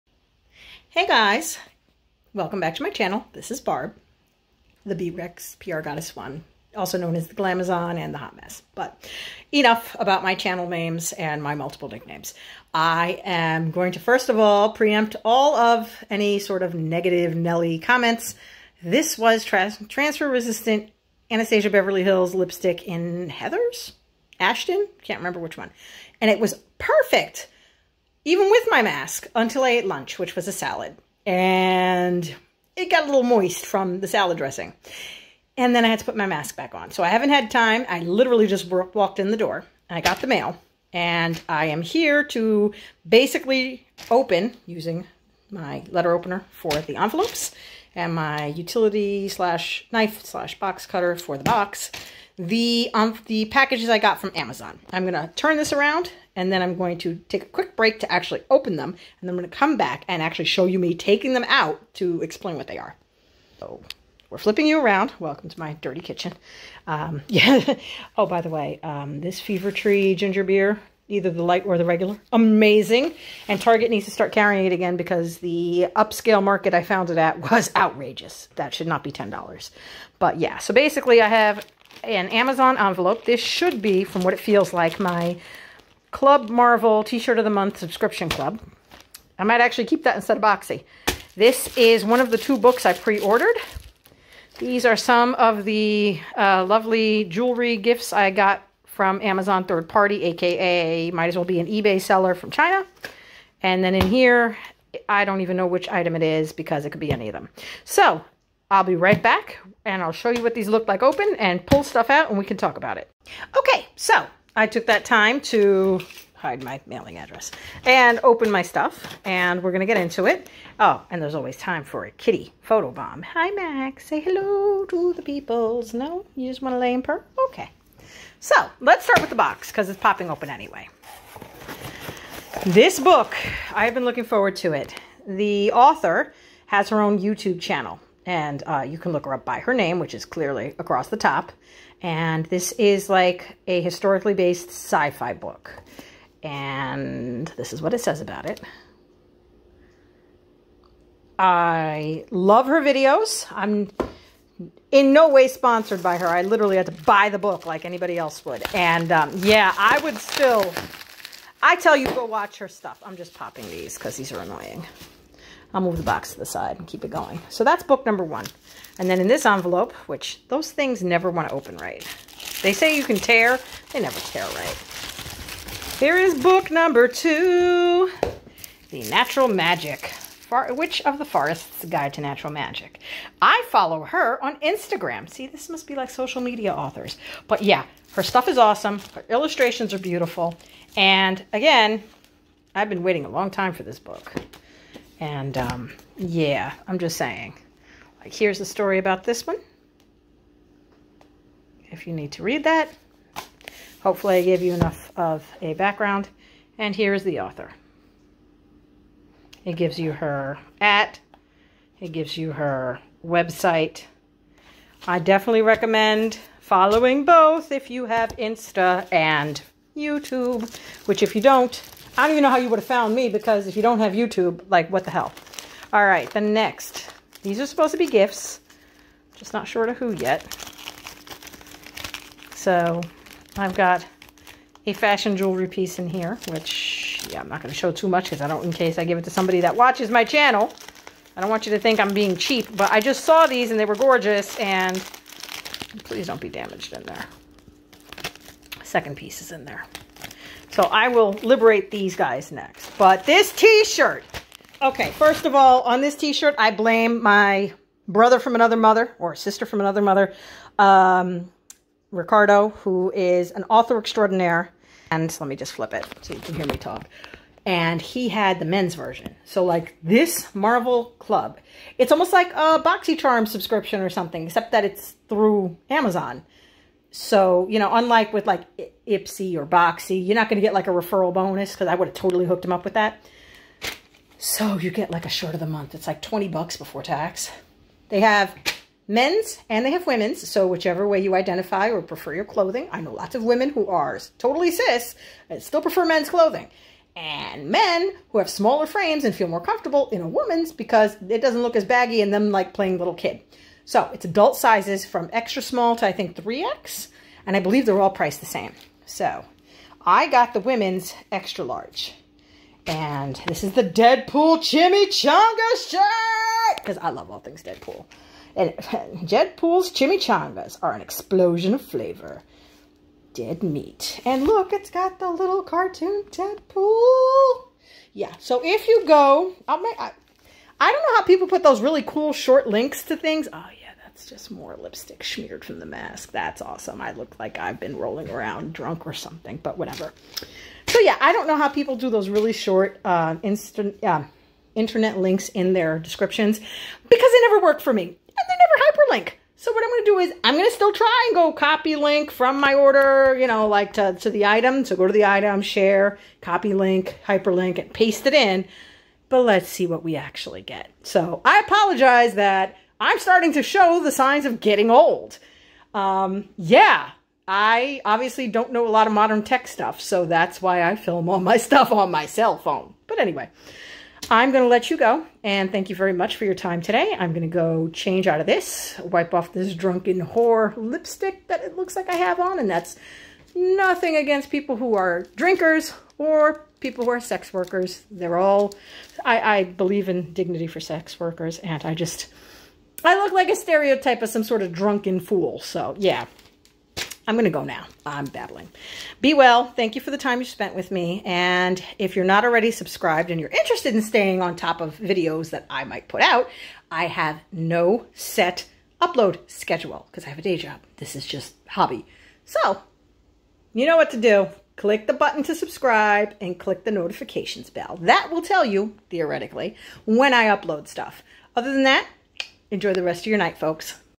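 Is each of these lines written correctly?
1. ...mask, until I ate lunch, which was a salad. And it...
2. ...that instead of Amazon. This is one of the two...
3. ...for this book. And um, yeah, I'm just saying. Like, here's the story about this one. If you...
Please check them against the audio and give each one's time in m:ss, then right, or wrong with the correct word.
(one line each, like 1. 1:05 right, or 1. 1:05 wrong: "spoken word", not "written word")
1. 0:28 right
2. 1:30 wrong: "Boxy", not "Amazon"
3. 3:13 right.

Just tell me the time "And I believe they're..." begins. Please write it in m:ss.
5:07.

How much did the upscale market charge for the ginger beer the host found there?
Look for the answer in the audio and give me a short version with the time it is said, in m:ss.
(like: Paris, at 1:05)
$10, at 1:19.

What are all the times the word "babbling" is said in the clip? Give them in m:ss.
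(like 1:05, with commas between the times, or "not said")
6:38.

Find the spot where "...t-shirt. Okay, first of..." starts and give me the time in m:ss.
4:13.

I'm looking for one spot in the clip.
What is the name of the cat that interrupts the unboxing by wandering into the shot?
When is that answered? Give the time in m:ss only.
2:03.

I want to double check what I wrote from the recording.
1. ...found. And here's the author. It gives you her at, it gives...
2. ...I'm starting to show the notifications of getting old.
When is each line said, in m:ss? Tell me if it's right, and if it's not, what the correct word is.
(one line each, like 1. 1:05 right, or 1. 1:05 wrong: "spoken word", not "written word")
1. 3:25 wrong: "background", not "found"
2. 6:02 wrong: "signs", not "notifications".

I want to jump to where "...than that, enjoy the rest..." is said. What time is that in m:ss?
7:01.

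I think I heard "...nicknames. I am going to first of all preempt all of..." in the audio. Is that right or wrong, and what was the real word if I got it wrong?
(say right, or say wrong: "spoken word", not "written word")
right.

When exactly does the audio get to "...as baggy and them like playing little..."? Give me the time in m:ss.
5:01.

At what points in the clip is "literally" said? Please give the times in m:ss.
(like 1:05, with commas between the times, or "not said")
0:38, 2:36.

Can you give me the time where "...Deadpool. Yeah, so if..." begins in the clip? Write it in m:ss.
5:26.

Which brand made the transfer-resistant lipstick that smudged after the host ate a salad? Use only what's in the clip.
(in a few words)
Anastasia Beverly Hills.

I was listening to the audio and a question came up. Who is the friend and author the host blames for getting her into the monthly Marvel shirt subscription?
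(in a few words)
Ricardo.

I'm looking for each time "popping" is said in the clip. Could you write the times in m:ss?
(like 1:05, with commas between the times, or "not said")
2:09, 2:43.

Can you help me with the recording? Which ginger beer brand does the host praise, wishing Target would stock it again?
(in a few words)
Fever Tree.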